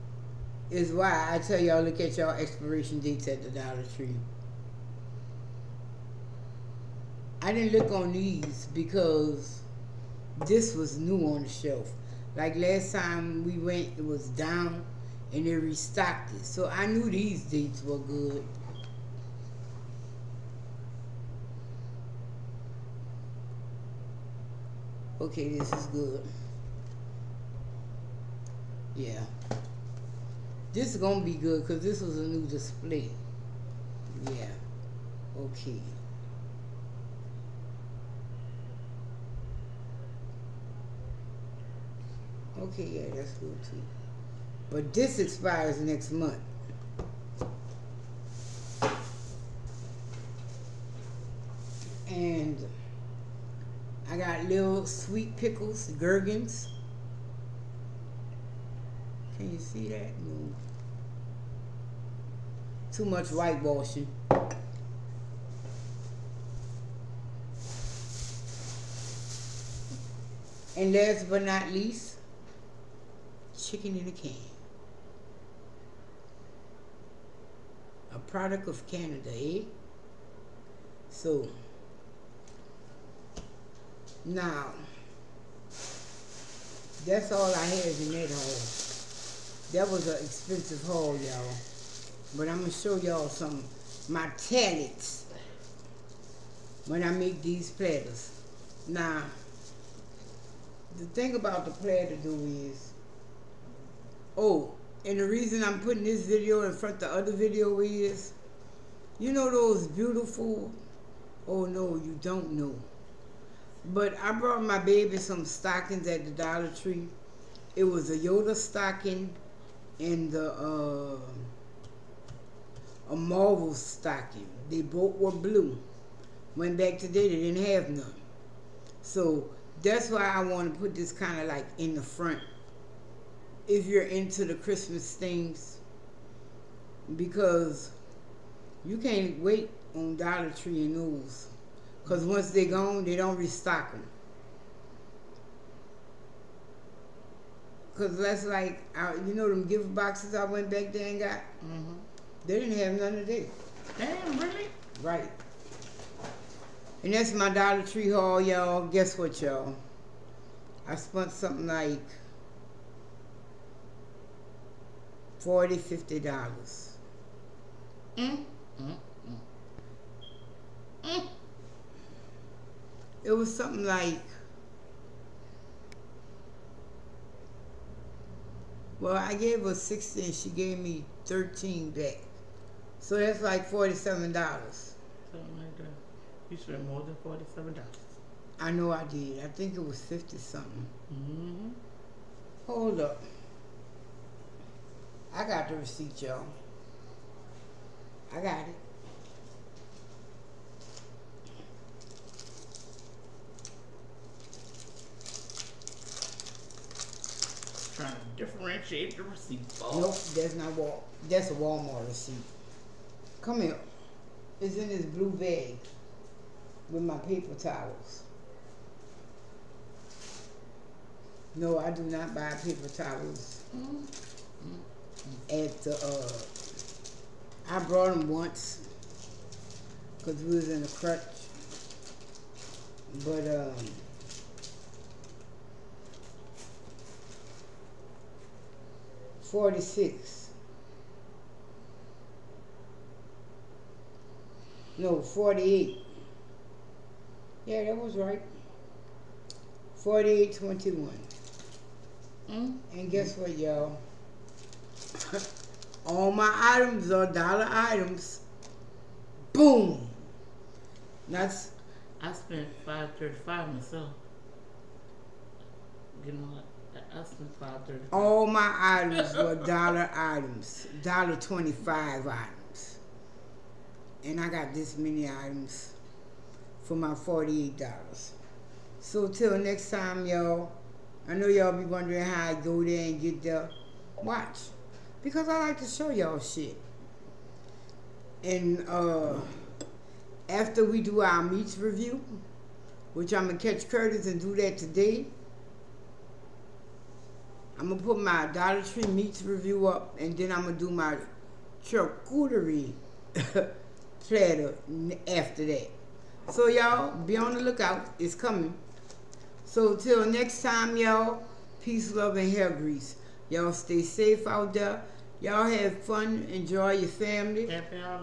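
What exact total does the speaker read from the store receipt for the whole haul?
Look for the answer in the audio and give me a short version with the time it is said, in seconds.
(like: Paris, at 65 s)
$48.21, at 249 s.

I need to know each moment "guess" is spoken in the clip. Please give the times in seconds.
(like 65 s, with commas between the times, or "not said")
158 s, 253 s.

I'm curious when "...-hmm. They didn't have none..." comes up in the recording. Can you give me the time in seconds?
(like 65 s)
151 s.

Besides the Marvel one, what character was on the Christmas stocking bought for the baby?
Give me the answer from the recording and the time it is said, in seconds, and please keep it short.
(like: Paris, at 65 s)
Yoda, at 118 s.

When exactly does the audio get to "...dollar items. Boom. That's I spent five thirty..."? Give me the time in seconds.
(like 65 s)
257 s.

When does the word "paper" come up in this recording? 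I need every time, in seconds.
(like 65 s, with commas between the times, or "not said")
217 s, 222 s.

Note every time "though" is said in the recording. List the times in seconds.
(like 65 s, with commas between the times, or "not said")
102 s.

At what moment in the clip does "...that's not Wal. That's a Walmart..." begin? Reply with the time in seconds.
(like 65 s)
210 s.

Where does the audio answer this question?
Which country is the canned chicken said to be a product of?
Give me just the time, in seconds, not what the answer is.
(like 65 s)
78 s.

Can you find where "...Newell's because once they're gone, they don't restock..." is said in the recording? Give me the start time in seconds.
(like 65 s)
140 s.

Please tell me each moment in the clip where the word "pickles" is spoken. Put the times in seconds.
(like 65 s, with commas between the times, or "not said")
55 s.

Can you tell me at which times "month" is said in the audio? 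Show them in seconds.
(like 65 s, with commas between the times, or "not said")
46 s.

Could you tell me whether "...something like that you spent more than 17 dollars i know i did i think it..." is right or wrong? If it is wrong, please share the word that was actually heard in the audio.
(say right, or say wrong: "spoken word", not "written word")
wrong: "47", not "17".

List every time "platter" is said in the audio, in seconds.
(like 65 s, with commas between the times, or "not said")
97 s, 101 s, 304 s.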